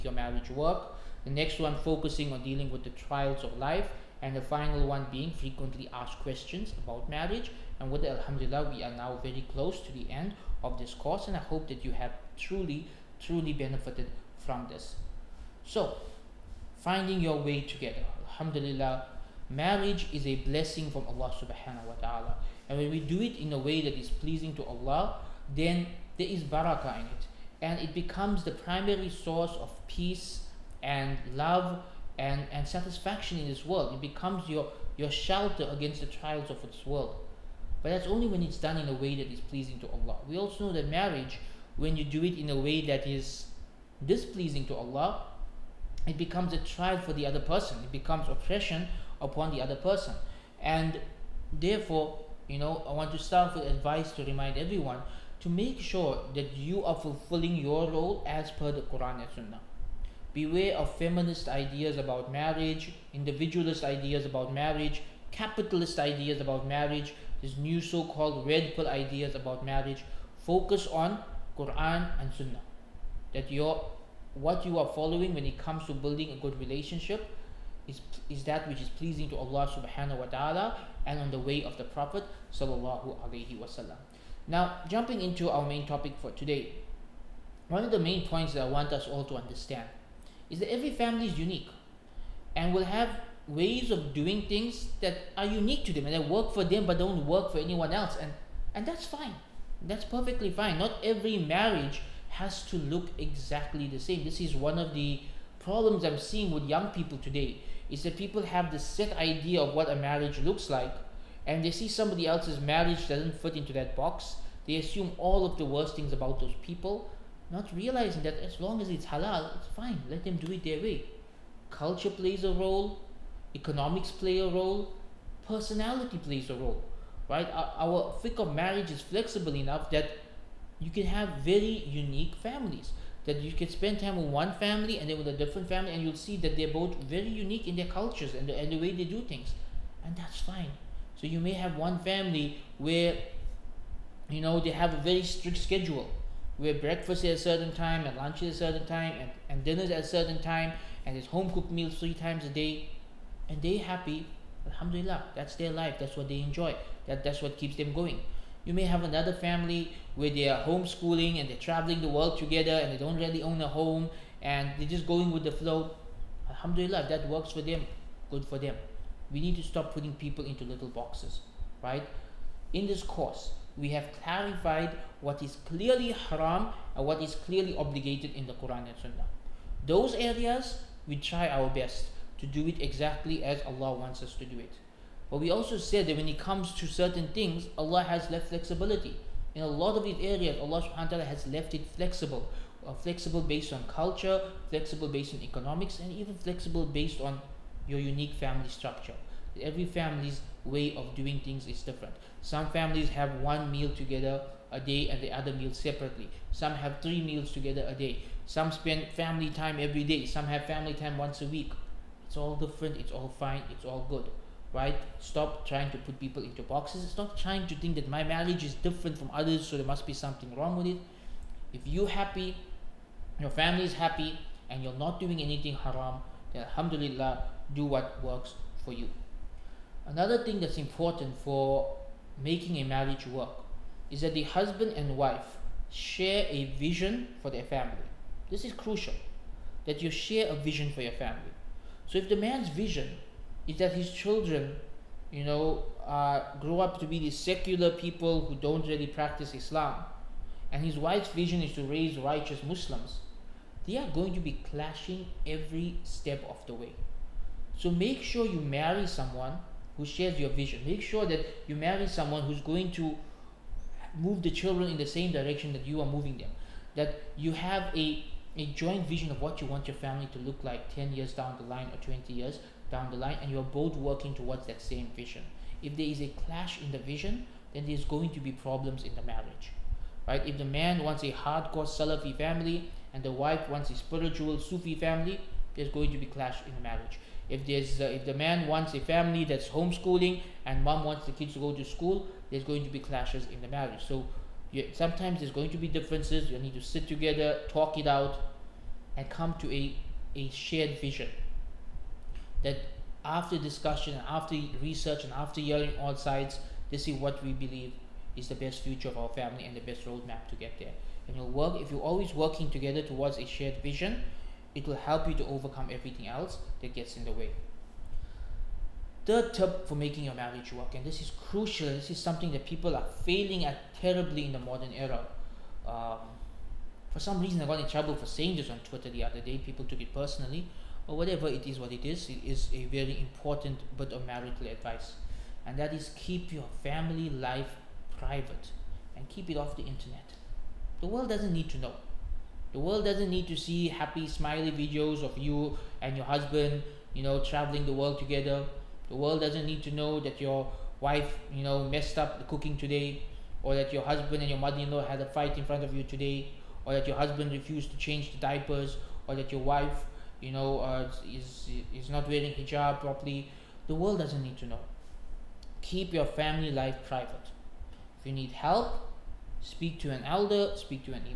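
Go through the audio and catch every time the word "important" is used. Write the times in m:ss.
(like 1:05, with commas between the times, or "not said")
3:50, 5:33.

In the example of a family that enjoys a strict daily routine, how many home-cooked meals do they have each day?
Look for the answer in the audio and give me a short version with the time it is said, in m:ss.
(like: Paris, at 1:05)
3, at 2:31.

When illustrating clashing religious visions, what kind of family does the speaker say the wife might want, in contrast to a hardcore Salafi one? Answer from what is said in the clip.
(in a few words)
A spiritual Sufi family.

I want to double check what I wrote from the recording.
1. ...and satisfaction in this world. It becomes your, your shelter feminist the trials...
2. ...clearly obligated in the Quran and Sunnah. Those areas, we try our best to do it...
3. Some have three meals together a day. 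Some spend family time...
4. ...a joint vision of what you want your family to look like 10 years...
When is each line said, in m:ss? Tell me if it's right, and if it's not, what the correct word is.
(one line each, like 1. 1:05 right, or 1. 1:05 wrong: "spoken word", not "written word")
1. 0:32 wrong: "against", not "feminist"
2. 2:57 right
3. 3:26 right
4. 4:28 right.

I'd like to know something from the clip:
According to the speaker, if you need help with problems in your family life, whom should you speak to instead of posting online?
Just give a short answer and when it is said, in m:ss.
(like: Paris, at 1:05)
An elder, at 6:10.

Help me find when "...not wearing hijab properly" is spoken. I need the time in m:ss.
6:02.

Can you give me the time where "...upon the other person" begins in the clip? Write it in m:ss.
0:49.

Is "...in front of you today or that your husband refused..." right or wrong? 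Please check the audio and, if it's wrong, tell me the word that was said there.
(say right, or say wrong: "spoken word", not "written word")
right.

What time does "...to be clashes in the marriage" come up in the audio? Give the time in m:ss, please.
4:52.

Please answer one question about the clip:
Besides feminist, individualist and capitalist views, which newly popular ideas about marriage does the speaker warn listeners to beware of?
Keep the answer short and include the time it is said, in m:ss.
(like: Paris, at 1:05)
Red pill ideas, at 1:08.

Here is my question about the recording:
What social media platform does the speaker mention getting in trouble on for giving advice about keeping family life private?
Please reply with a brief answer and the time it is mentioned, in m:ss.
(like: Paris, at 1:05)
Twitter, at 5:28.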